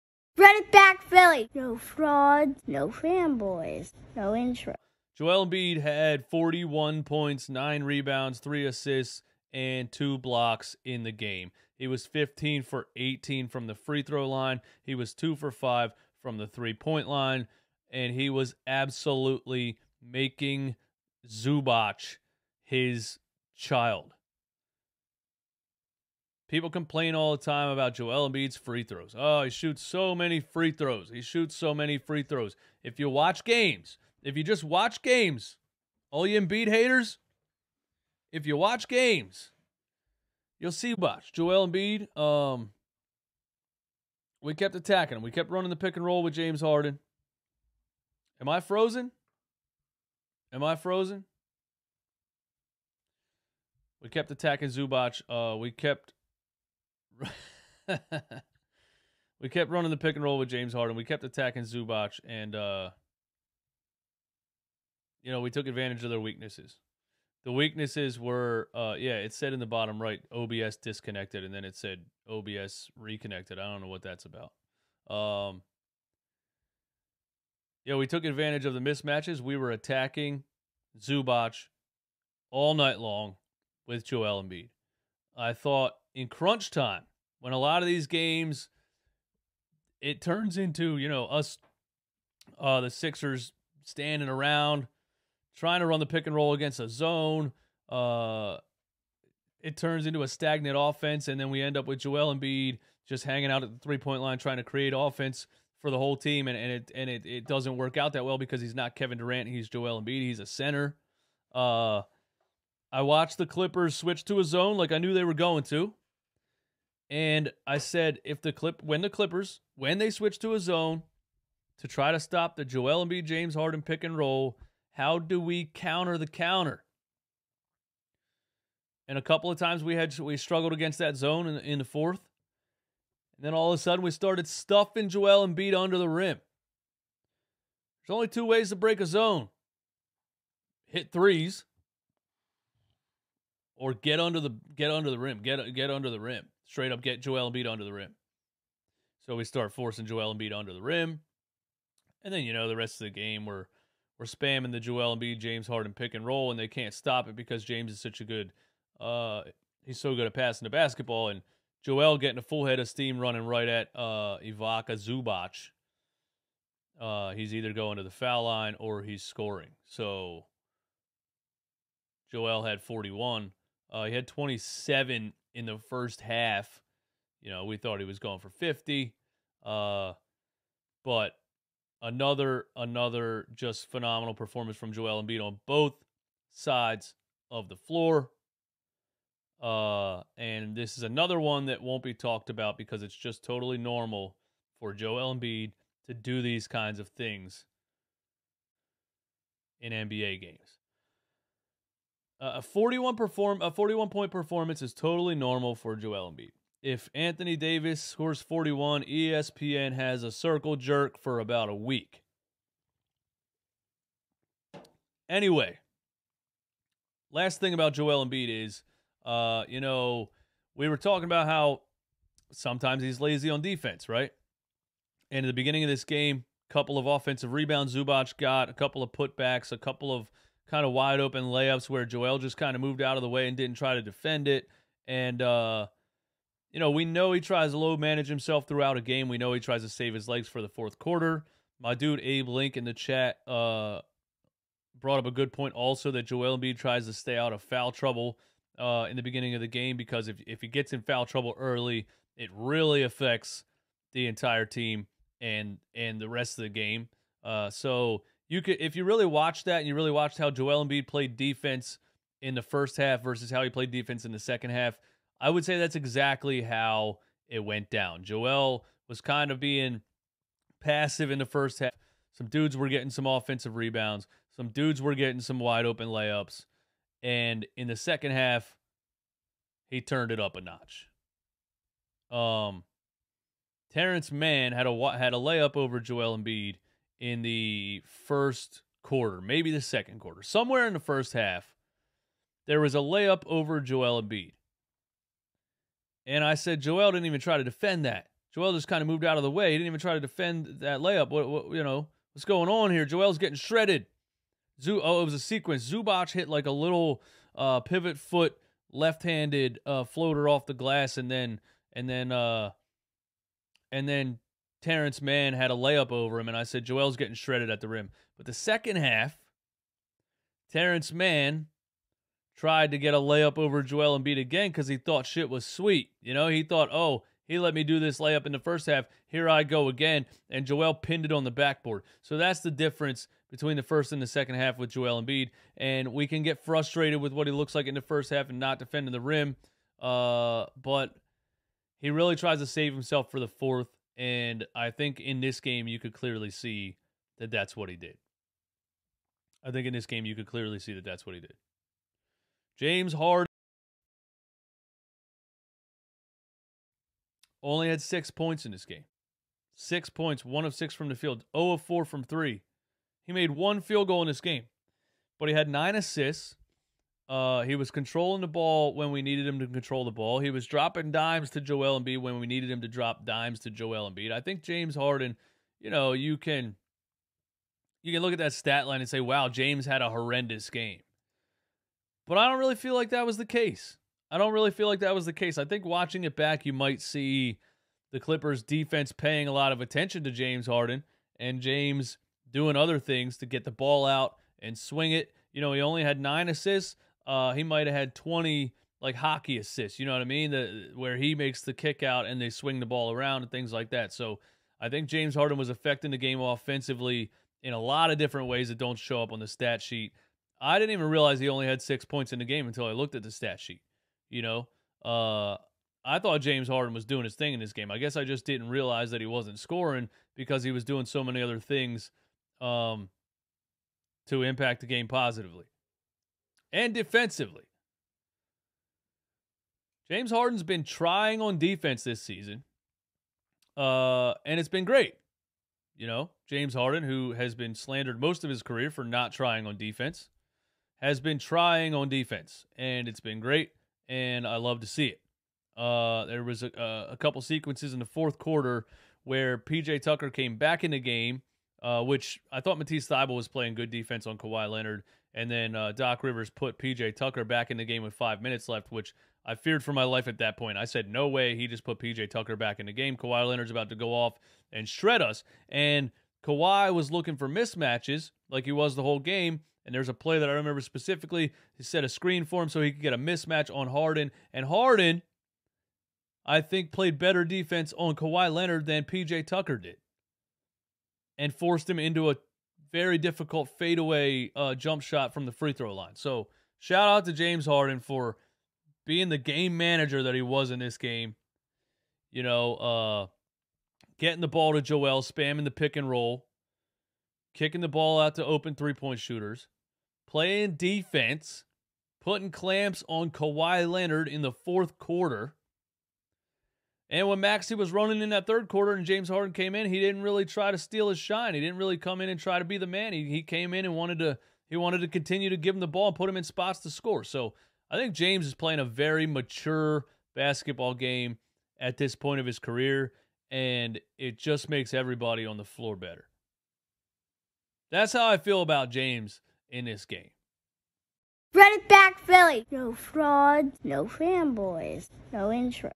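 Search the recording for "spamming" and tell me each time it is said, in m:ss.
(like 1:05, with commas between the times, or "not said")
2:34, 8:15.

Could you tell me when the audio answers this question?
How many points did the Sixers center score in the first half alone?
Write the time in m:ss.
2:54.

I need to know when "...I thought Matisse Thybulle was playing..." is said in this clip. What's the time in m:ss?
7:32.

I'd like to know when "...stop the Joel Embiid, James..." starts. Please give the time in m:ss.
2:02.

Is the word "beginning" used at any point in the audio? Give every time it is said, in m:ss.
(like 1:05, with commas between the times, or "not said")
3:45, 4:09.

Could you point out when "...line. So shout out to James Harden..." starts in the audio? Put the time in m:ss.
8:05.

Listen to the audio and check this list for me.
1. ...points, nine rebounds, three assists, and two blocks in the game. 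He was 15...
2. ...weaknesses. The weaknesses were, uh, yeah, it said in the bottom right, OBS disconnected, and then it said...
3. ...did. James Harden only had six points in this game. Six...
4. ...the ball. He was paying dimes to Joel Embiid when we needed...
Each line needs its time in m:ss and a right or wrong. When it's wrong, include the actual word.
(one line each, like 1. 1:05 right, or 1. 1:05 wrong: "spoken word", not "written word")
1. 0:07 right
2. 1:06 right
3. 5:51 right
4. 6:10 wrong: "dropping", not "paying".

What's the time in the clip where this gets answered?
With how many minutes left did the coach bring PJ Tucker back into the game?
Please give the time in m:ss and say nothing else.
7:38.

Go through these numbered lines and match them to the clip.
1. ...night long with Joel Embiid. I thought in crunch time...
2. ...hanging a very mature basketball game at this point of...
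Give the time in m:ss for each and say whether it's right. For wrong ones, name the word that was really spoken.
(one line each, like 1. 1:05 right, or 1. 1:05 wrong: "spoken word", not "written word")
1. 1:22 right
2. 8:38 wrong: "playing", not "hanging".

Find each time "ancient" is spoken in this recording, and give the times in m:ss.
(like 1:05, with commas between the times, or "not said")
not said.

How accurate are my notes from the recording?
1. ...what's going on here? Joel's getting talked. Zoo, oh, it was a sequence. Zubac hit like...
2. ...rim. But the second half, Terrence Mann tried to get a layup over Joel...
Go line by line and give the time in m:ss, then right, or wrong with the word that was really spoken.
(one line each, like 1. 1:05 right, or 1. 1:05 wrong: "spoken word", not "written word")
1. 5:02 wrong: "shredded", not "talked"
2. 5:17 right.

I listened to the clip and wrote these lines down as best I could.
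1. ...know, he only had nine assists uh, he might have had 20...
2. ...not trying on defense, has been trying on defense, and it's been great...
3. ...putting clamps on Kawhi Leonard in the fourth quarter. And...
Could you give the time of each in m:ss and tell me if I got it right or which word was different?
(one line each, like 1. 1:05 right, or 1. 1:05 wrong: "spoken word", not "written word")
1. 6:35 right
2. 7:19 right
3. 8:22 right.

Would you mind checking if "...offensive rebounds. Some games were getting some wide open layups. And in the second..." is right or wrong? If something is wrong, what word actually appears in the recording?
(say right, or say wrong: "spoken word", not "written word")
wrong: "dudes", not "games".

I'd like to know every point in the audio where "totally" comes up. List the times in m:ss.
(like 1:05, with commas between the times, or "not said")
3:13, 3:24.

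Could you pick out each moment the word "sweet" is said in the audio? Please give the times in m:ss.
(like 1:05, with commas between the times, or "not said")
5:25.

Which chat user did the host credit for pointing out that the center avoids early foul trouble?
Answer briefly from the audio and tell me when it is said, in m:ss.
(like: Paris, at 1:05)
Abe Link, at 4:02.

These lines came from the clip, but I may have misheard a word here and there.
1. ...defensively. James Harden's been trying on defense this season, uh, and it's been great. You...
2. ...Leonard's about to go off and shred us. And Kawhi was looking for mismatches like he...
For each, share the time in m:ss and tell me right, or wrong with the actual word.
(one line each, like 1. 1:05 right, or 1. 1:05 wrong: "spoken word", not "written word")
1. 7:06 right
2. 7:43 right.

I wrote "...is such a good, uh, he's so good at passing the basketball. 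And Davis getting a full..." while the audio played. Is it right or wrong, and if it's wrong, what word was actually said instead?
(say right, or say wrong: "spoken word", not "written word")
wrong: "Joel", not "Davis".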